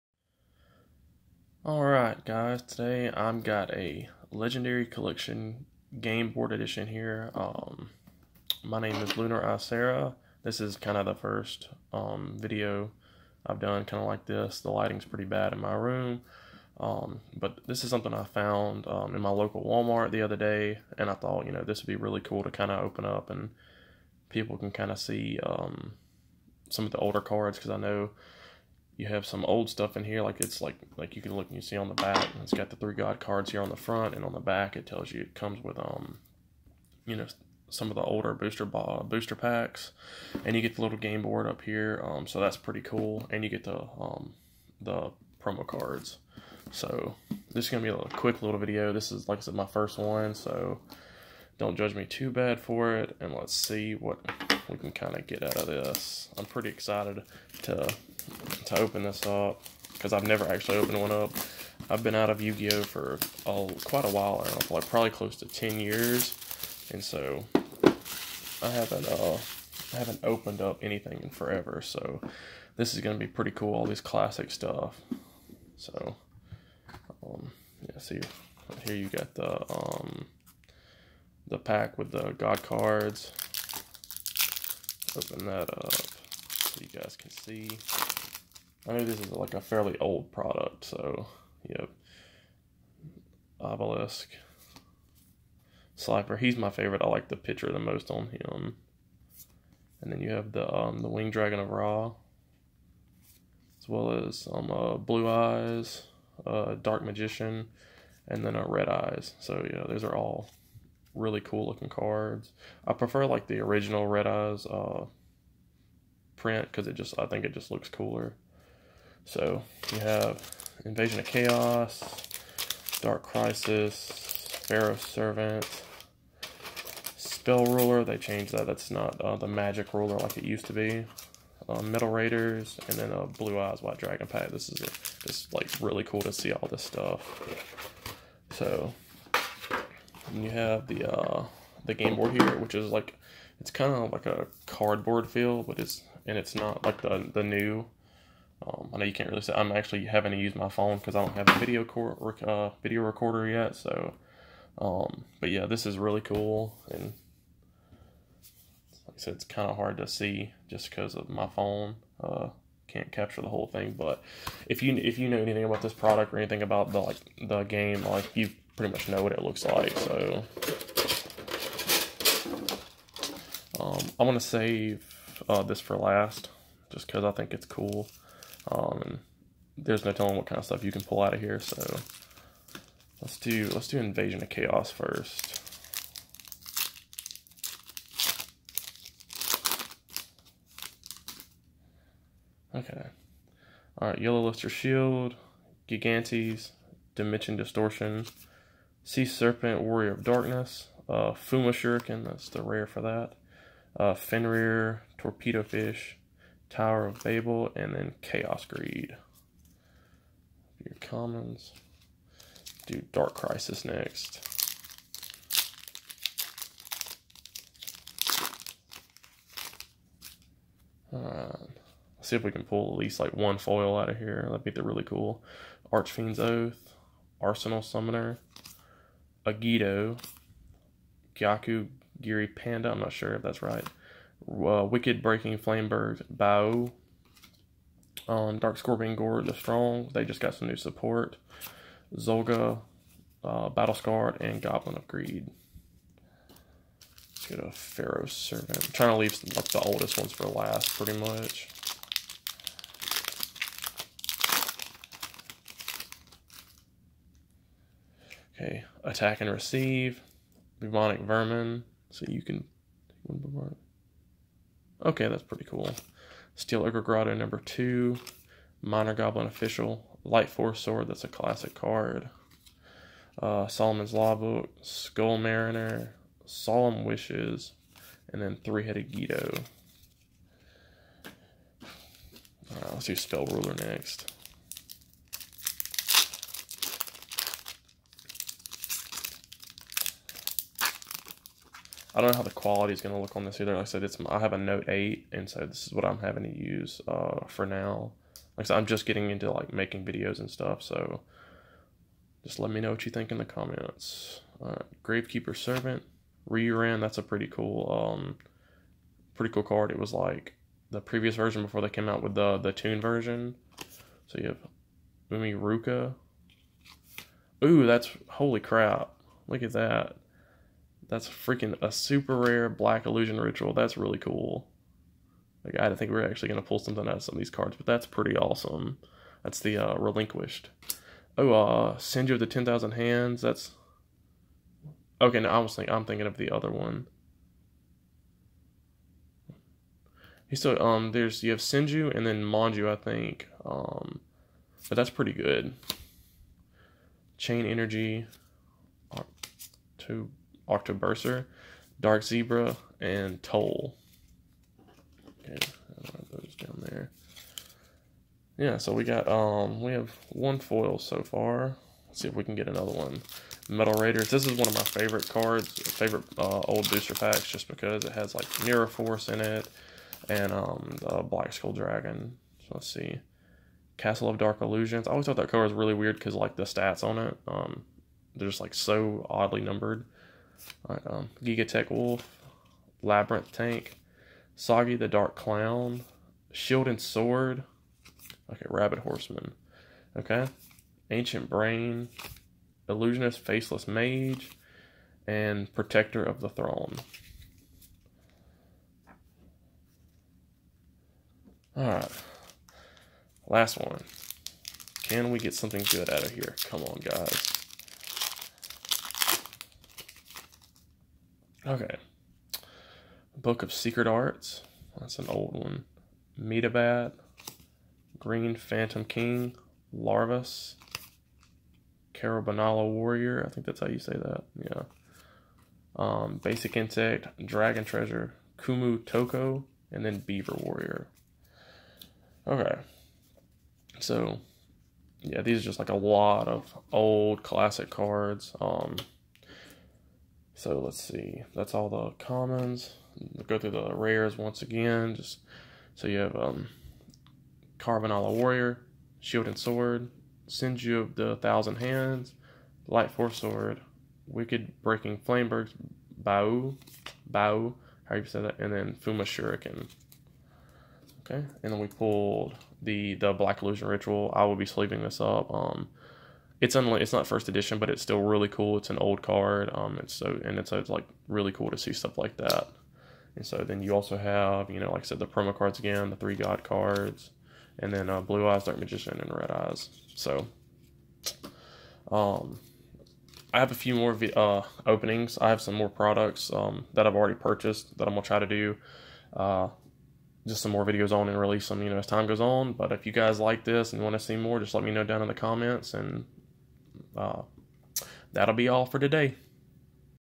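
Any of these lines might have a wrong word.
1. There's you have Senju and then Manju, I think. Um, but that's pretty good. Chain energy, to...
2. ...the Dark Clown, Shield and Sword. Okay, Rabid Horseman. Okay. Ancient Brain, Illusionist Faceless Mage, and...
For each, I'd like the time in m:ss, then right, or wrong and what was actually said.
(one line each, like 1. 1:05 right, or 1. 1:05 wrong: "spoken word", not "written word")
1. 5:41 right
2. 6:24 right.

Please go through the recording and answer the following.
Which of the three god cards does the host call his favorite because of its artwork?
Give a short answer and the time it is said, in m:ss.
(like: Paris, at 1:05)
Slifer, at 1:35.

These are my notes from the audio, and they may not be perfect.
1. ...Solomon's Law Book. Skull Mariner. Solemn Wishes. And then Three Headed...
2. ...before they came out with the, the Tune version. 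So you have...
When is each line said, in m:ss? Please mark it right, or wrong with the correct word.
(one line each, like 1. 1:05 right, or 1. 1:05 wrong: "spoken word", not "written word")
1. 4:33 right
2. 5:11 right.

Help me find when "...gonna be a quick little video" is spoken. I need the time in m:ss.
0:47.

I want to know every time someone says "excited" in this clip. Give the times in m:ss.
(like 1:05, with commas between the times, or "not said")
0:56.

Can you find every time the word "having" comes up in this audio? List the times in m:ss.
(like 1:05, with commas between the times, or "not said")
2:30, 4:56.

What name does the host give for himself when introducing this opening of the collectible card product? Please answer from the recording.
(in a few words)
Lunar Isara.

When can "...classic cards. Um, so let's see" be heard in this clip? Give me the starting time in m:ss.
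7:17.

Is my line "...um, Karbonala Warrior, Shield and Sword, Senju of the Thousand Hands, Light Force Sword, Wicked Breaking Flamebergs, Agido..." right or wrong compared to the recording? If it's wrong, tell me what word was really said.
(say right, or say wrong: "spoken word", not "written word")
wrong: "Bao", not "Agido".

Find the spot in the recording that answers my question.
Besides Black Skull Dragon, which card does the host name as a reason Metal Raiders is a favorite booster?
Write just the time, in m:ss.
6:08.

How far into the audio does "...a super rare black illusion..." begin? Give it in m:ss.
5:21.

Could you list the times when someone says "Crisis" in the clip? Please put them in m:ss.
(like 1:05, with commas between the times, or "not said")
2:03, 3:33.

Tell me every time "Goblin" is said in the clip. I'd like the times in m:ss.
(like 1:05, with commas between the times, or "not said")
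4:04, 4:29.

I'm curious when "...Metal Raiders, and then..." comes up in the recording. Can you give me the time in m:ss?
2:11.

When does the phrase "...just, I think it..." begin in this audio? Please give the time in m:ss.
1:56.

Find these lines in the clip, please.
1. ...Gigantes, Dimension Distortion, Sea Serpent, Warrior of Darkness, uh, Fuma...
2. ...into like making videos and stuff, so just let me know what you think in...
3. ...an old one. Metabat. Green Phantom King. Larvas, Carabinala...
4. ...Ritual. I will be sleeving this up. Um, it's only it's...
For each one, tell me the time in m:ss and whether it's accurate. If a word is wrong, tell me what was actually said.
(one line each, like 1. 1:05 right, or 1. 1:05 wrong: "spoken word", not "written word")
1. 3:15 right
2. 4:59 right
3. 6:55 right
4. 7:43 right.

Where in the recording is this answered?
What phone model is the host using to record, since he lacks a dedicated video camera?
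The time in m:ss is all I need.
4:54.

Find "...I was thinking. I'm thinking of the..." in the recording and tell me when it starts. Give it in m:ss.
5:35.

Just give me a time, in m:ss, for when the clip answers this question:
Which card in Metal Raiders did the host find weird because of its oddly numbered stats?
6:13.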